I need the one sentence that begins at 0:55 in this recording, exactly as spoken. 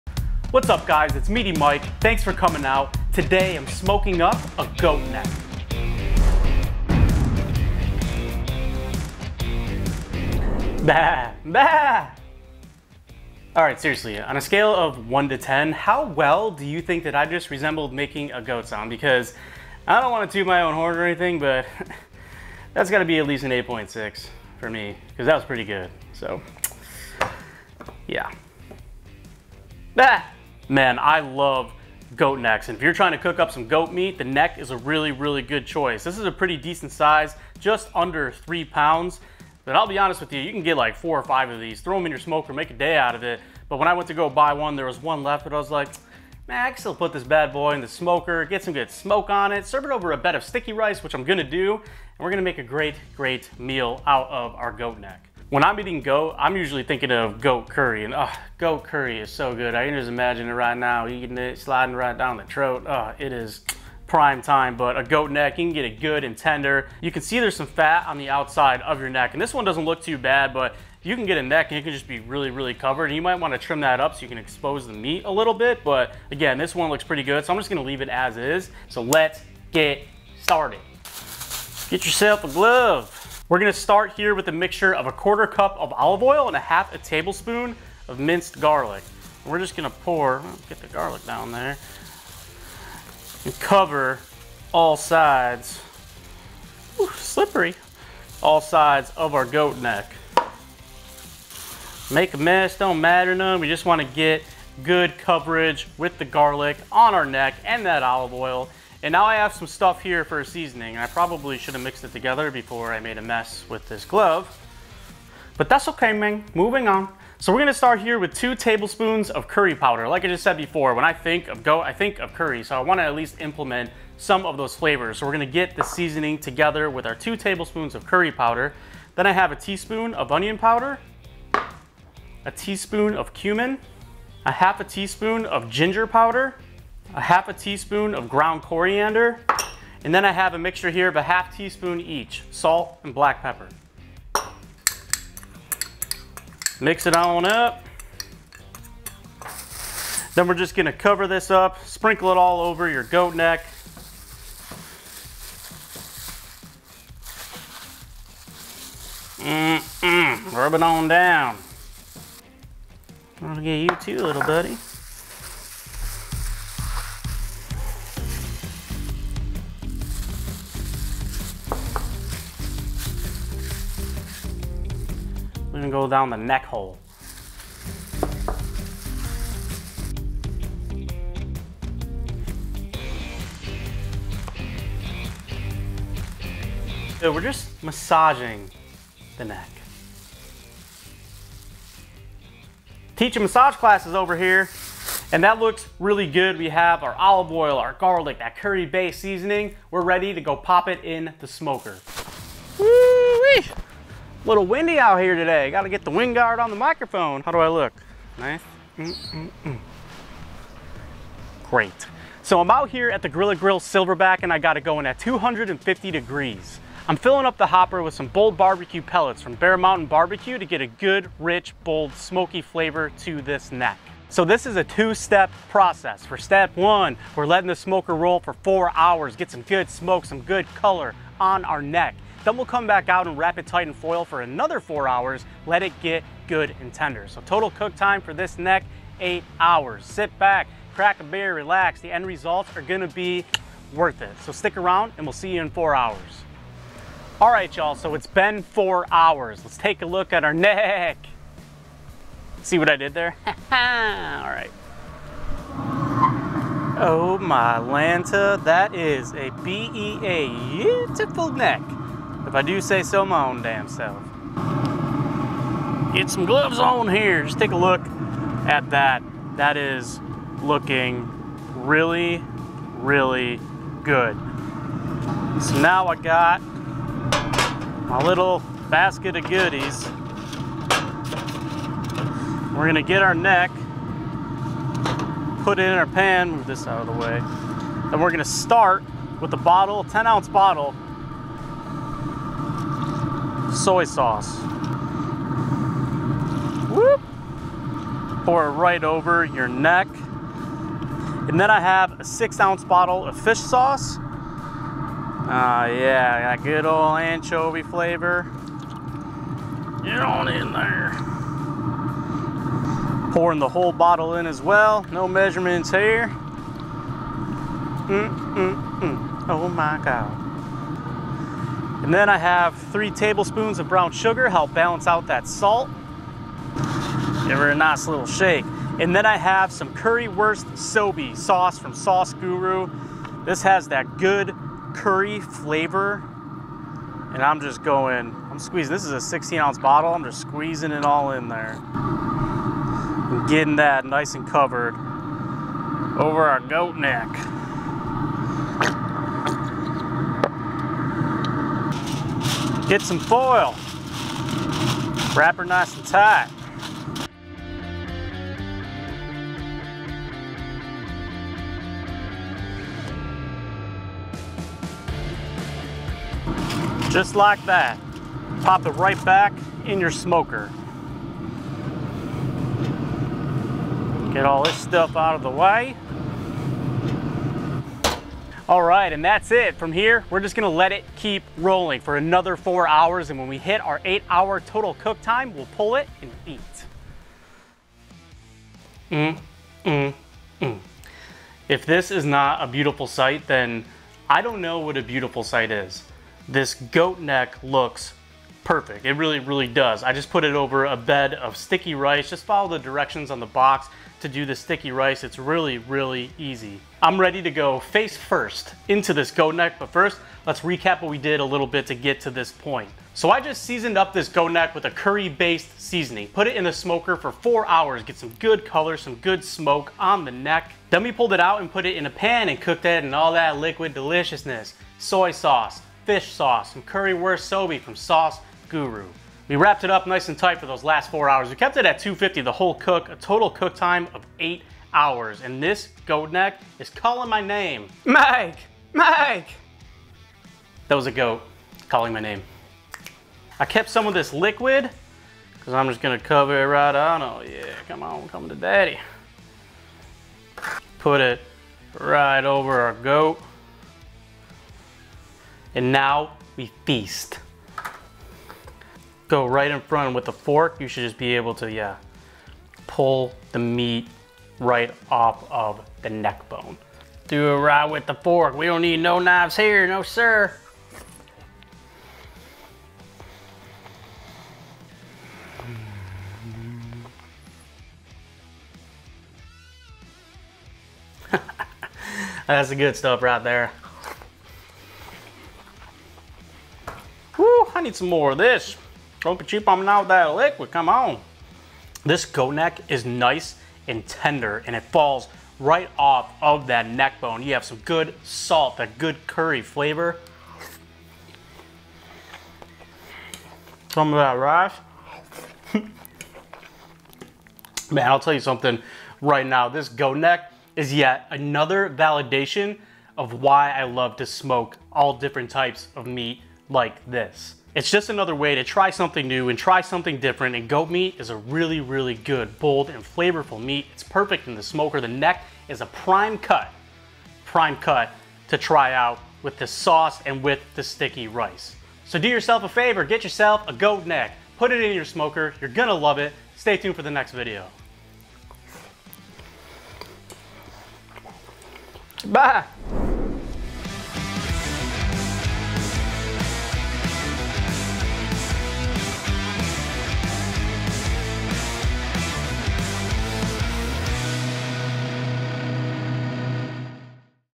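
When I'm eating goat, I'm usually thinking of goat curry, and oh, goat curry is so good.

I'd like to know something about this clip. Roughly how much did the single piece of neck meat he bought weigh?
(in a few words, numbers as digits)
just under 3 pounds.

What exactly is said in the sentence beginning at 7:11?
We kept it at 250 the whole cook, a total cook time of eight hours.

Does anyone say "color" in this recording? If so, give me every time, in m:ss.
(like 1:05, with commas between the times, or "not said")
3:50, 6:58.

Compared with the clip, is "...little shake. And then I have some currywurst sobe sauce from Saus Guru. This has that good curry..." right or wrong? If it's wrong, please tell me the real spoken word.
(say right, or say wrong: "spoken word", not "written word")
right.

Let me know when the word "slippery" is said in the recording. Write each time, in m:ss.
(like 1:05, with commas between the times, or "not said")
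1:37.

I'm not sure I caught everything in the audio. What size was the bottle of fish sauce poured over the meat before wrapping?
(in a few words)
6 ounce.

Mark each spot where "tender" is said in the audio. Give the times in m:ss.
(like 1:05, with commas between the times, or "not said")
1:06, 3:56, 8:14.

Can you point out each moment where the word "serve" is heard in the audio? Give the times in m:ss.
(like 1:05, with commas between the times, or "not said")
0:49.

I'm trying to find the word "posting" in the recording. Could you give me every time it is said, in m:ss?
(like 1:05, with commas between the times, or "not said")
not said.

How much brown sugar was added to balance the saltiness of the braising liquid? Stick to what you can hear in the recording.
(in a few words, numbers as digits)
3 tablespoons.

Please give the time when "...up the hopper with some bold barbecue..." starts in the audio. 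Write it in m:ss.
3:37.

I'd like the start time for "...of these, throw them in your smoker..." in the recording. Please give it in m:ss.
0:41.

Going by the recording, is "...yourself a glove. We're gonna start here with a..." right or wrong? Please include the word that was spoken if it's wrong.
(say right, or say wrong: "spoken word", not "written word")
right.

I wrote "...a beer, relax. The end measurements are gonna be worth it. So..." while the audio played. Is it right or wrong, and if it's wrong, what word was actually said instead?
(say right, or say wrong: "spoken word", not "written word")
wrong: "results", not "measurements".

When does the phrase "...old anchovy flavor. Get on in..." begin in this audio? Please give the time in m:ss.
5:06.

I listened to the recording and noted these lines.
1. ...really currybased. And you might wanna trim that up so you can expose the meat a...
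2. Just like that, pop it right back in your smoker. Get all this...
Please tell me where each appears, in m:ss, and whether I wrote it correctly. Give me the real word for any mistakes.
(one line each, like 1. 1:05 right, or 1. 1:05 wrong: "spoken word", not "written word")
1. 1:12 wrong: "covered", not "currybased"
2. 6:07 right.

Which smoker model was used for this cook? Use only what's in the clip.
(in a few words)
Grilla Grill Silverbac.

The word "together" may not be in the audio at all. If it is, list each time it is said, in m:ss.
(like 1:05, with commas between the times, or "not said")
1:52, 2:06.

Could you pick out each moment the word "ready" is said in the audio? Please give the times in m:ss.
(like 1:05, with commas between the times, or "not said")
3:20, 6:47.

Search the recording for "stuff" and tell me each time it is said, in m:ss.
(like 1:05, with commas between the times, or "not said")
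1:49, 6:14, 8:02.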